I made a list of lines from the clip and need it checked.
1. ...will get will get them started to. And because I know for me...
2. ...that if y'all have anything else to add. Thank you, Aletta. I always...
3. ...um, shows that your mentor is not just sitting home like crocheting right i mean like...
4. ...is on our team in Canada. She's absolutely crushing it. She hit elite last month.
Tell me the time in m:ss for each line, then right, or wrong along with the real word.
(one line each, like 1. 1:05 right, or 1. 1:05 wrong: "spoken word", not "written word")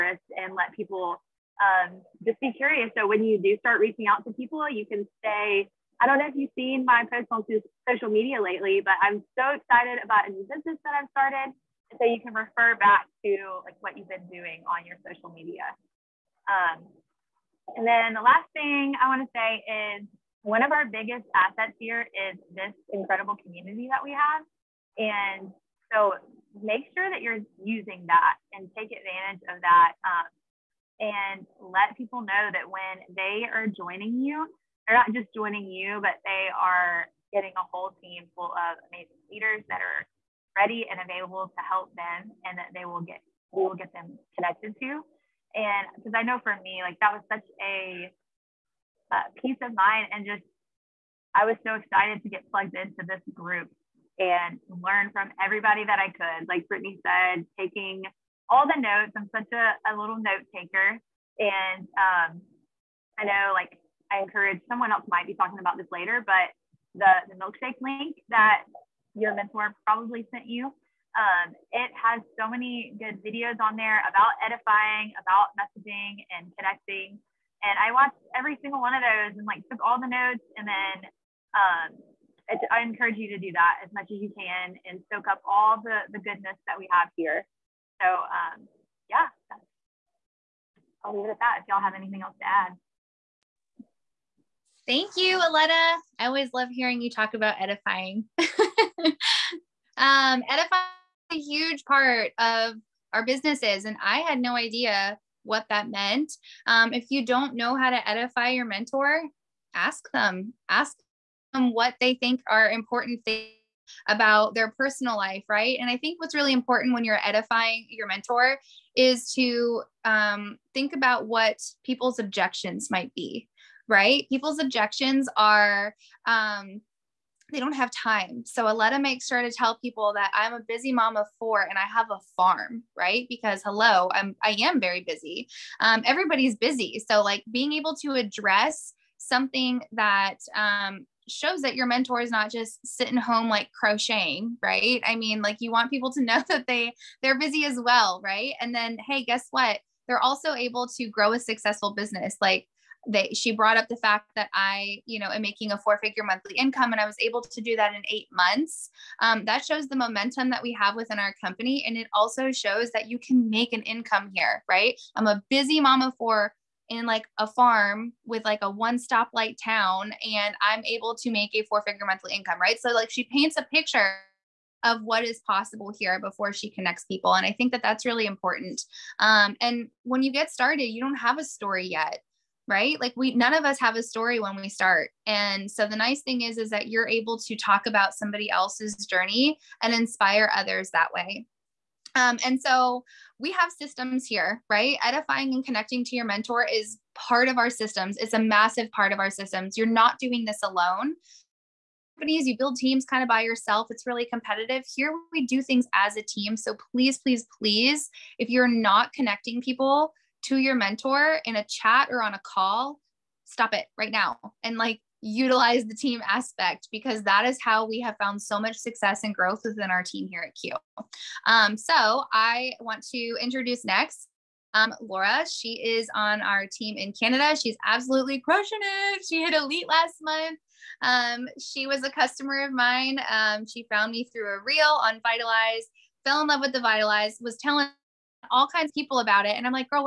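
1. 0:42 wrong: "connected", not "started"
2. 1:31 right
3. 2:20 right
4. 3:45 right.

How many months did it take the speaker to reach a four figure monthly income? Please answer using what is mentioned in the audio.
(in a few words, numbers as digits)
8.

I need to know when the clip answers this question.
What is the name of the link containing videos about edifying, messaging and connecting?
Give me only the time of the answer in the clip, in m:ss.
1:07.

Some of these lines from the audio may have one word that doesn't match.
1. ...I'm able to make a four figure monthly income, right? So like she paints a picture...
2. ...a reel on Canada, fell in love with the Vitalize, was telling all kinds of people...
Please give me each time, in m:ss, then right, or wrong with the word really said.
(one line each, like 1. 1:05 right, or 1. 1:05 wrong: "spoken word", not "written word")
1. 2:50 right
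2. 3:54 wrong: "Vitalize", not "Canada".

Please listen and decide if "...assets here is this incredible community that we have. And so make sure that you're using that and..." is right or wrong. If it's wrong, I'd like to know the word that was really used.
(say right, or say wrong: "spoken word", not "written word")
right.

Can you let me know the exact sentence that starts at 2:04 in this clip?
People's objections are, um, they don't have time.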